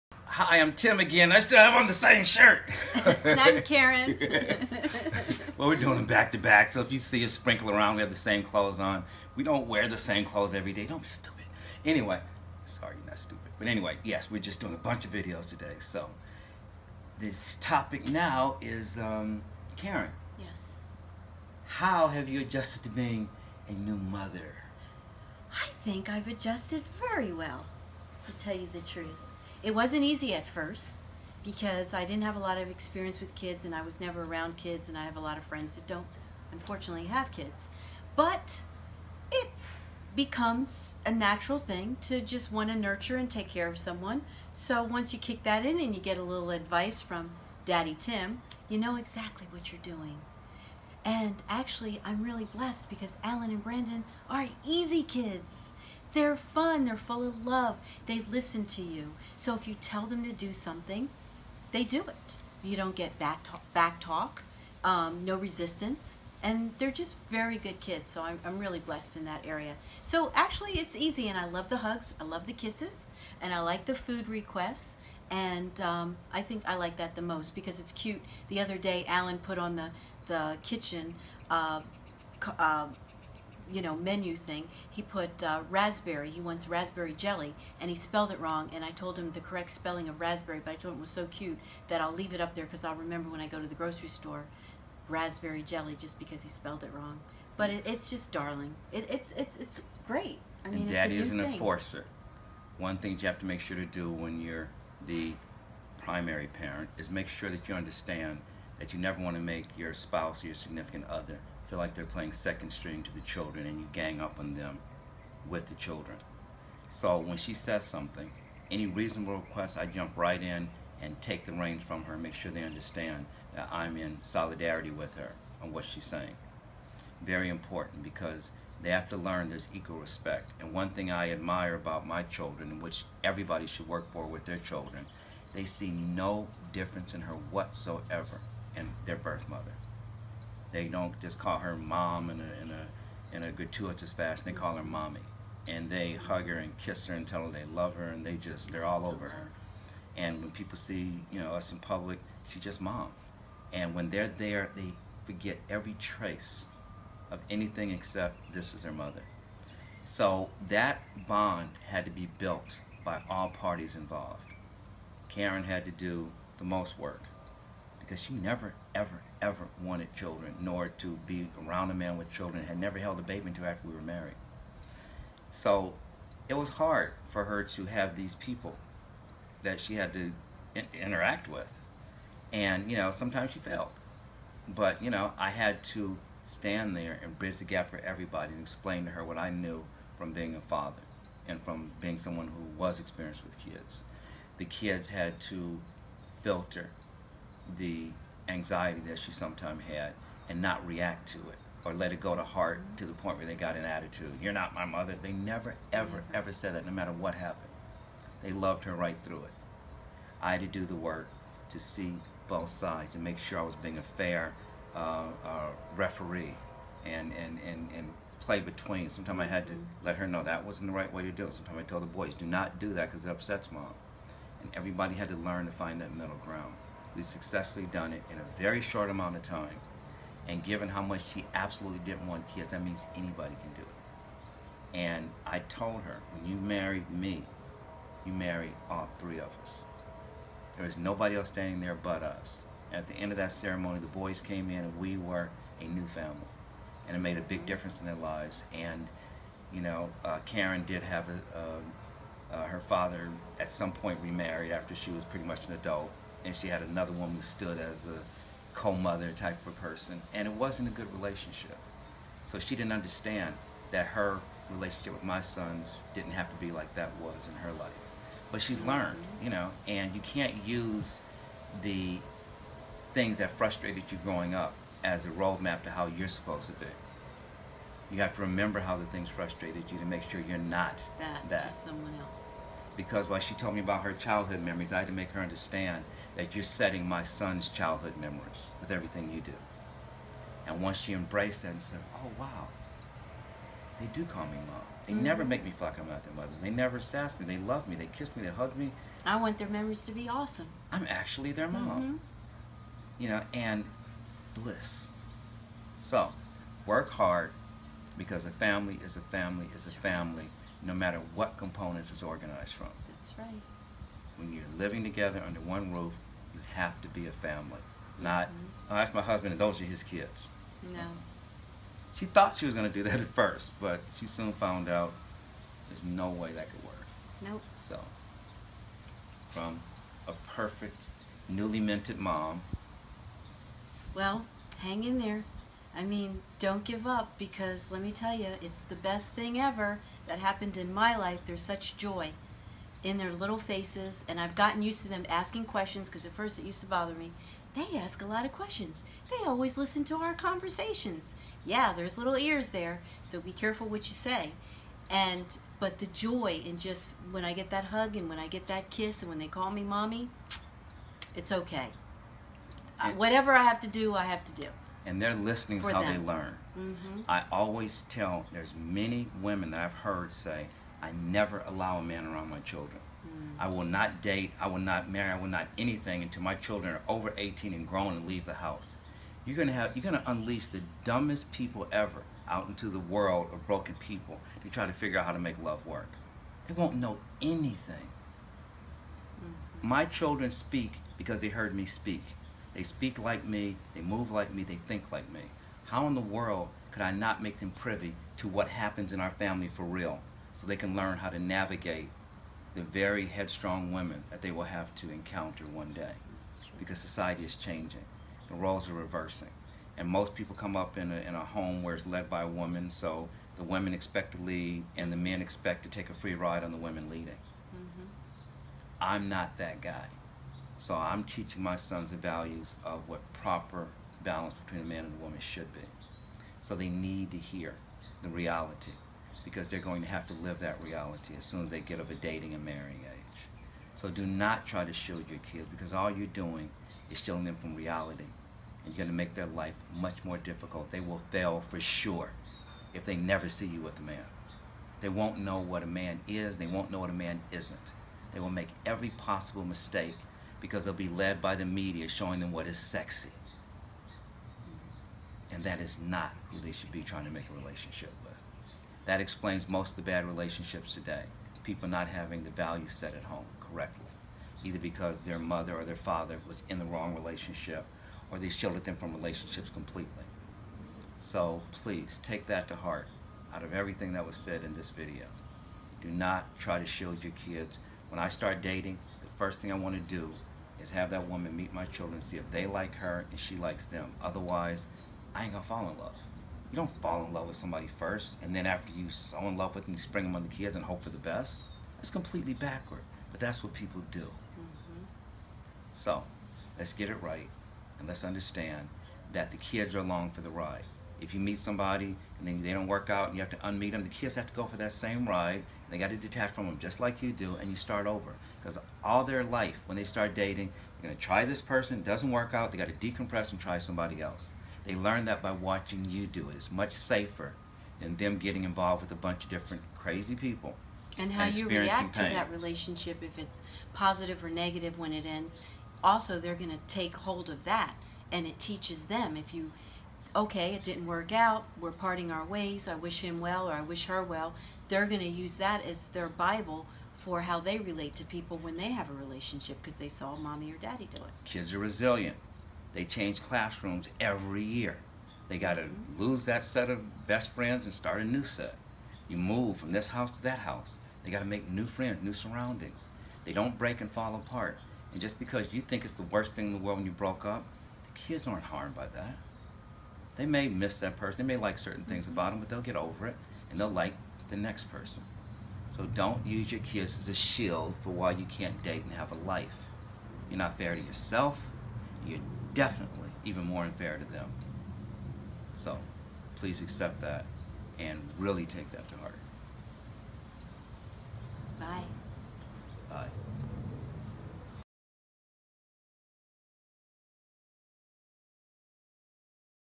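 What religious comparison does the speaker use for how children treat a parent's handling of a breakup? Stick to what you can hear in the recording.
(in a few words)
Their Bible.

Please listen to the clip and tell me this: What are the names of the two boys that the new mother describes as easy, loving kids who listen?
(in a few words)
Alan and Brandon.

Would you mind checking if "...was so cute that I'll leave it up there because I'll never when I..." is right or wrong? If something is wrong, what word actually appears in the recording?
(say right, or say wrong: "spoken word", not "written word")
wrong: "remember", not "never".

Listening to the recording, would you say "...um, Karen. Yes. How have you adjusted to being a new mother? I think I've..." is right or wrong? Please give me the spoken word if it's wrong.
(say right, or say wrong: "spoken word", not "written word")
right.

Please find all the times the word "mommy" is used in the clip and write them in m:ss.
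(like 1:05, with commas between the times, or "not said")
2:24, 5:59, 9:00.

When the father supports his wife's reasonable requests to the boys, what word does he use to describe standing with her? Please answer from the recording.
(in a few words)
Solidarity.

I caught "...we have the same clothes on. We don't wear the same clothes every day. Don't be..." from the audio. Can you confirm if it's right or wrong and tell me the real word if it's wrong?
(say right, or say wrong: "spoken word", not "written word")
right.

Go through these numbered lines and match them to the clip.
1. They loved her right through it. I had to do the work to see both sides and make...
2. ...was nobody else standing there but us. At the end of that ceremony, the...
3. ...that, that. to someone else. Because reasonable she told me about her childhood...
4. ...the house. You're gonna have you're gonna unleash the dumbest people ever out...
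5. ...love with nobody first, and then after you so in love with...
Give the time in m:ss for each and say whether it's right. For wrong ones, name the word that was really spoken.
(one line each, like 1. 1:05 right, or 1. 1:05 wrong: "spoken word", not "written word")
1. 3:28 right
2. 4:00 right
3. 4:41 wrong: "while", not "reasonable"
4. 6:18 right
5. 8:07 wrong: "somebody", not "nobody".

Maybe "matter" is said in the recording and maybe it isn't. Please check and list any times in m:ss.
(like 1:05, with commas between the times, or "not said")
3:26, 5:10.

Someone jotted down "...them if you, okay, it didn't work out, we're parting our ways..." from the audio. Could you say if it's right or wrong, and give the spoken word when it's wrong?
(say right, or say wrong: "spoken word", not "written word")
right.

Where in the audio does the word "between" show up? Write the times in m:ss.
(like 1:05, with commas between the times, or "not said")
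3:38, 7:04.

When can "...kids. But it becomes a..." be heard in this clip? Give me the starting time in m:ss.
0:37.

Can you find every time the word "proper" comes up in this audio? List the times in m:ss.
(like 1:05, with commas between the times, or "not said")
7:03.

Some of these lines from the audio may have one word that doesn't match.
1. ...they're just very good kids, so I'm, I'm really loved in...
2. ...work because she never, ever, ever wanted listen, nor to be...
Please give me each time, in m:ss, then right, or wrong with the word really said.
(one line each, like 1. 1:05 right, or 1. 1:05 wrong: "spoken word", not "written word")
1. 1:06 wrong: "blessed", not "loved"
2. 2:46 wrong: "children", not "listen".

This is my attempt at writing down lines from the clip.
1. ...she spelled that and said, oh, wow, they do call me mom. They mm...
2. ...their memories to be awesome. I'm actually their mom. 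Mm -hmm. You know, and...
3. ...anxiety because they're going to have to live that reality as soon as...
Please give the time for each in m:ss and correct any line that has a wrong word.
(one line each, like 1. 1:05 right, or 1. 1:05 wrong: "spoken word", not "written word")
1. 4:50 wrong: "embraced", not "spelled"
2. 4:59 right
3. 7:08 wrong: "reality", not "anxiety".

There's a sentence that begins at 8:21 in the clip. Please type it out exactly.
If you meet somebody and then they don't work out, and you have to unmeet them.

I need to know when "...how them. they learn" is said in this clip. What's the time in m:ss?
6:05.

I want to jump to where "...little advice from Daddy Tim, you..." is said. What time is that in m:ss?
0:46.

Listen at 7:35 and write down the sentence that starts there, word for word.
And that is not who they should be trying to make a relationship that explains most of the bad relationships today.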